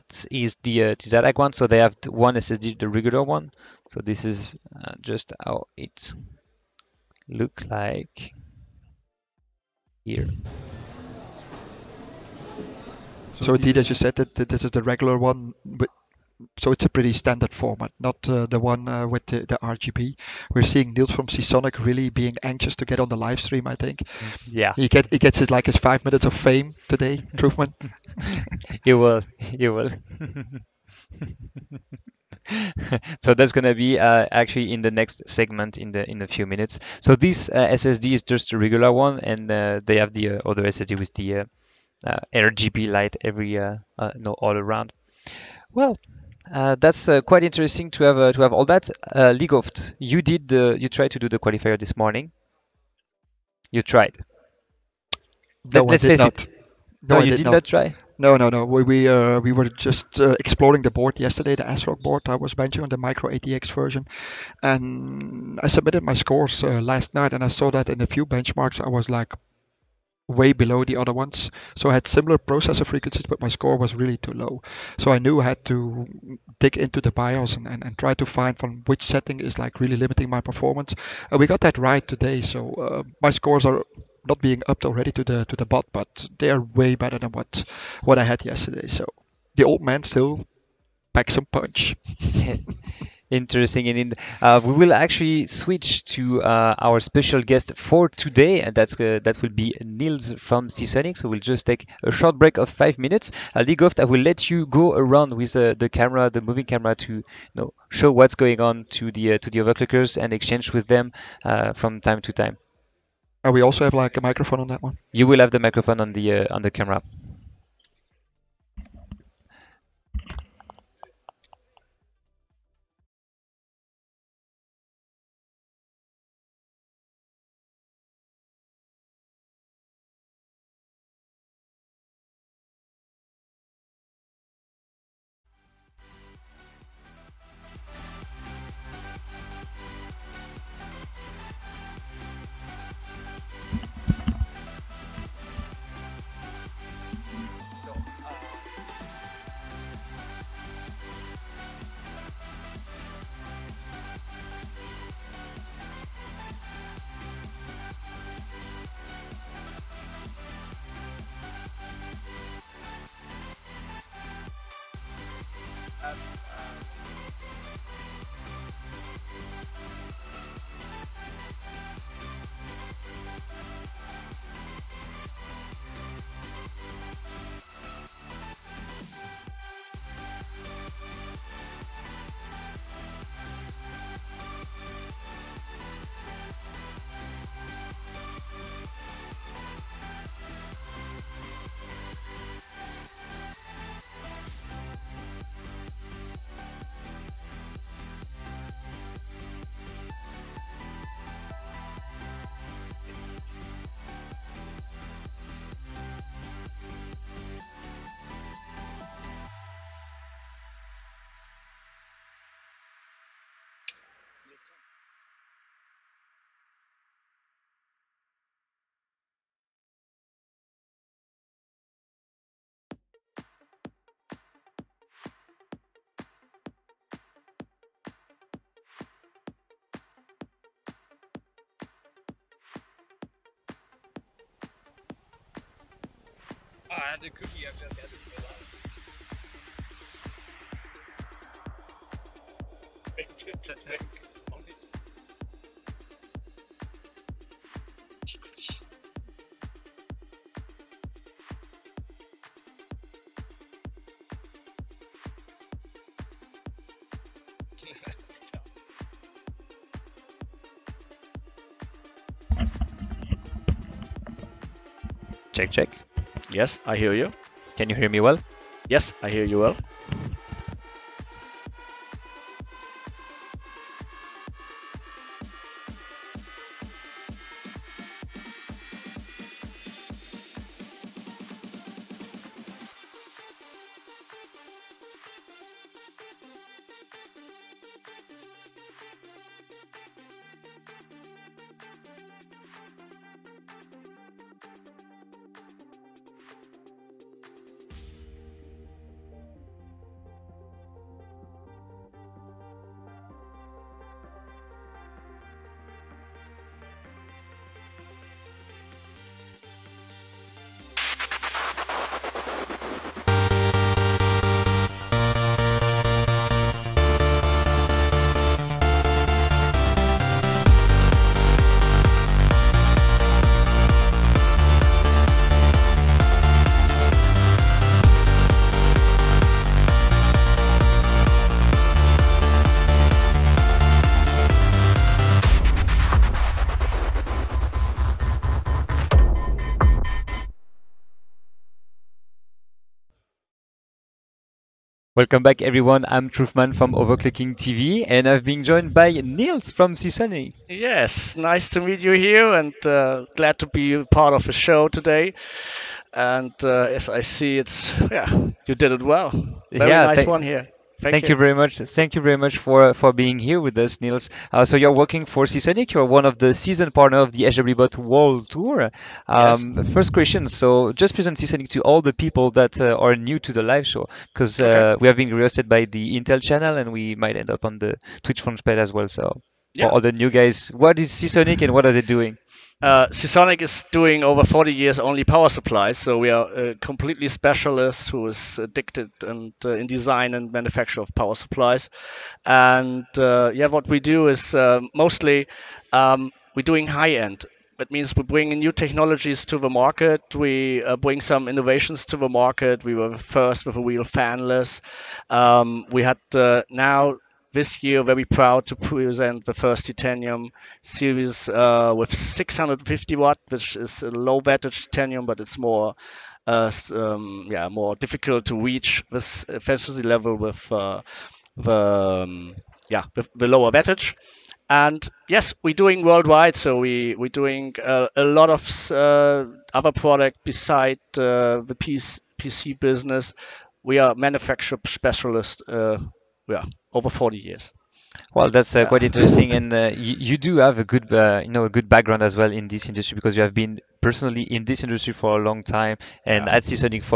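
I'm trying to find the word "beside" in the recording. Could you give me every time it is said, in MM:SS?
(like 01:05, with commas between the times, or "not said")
07:10.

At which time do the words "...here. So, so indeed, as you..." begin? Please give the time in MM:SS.
00:10.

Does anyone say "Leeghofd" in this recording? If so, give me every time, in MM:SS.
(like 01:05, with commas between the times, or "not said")
00:49, 01:43.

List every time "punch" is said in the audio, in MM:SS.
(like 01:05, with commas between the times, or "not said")
01:31.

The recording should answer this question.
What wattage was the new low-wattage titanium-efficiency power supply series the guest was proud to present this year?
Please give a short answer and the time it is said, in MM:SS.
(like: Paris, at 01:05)
650 watt, at 06:52.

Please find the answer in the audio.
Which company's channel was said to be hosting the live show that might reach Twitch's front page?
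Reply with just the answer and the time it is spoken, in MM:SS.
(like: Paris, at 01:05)
Intel, at 06:16.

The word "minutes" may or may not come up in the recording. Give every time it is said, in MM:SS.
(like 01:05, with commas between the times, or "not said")
00:26, 00:36, 01:42.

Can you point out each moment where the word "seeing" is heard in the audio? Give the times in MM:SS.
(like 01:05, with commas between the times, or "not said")
00:20.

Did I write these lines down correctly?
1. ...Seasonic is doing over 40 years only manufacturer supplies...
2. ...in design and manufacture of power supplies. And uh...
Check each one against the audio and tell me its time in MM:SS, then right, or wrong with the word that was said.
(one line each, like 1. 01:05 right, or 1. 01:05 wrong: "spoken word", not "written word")
1. 06:23 wrong: "power", not "manufacturer"
2. 06:29 right.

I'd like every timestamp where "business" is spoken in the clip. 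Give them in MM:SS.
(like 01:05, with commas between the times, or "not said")
07:12.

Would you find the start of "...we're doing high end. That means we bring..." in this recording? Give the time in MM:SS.
06:36.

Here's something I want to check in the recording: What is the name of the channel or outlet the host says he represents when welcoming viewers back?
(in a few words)
Overclocking TV.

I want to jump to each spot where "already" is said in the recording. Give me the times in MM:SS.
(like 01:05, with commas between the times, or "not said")
01:24.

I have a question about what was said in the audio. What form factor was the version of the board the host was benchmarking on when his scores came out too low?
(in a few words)
Micro ATX.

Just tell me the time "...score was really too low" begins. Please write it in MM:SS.
01:13.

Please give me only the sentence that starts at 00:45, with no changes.
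Well, uh, that's uh, quite interesting to have uh, to have all that.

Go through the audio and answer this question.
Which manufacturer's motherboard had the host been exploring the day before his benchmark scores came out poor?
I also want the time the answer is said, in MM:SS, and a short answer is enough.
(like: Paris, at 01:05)
ASRock, at 01:01.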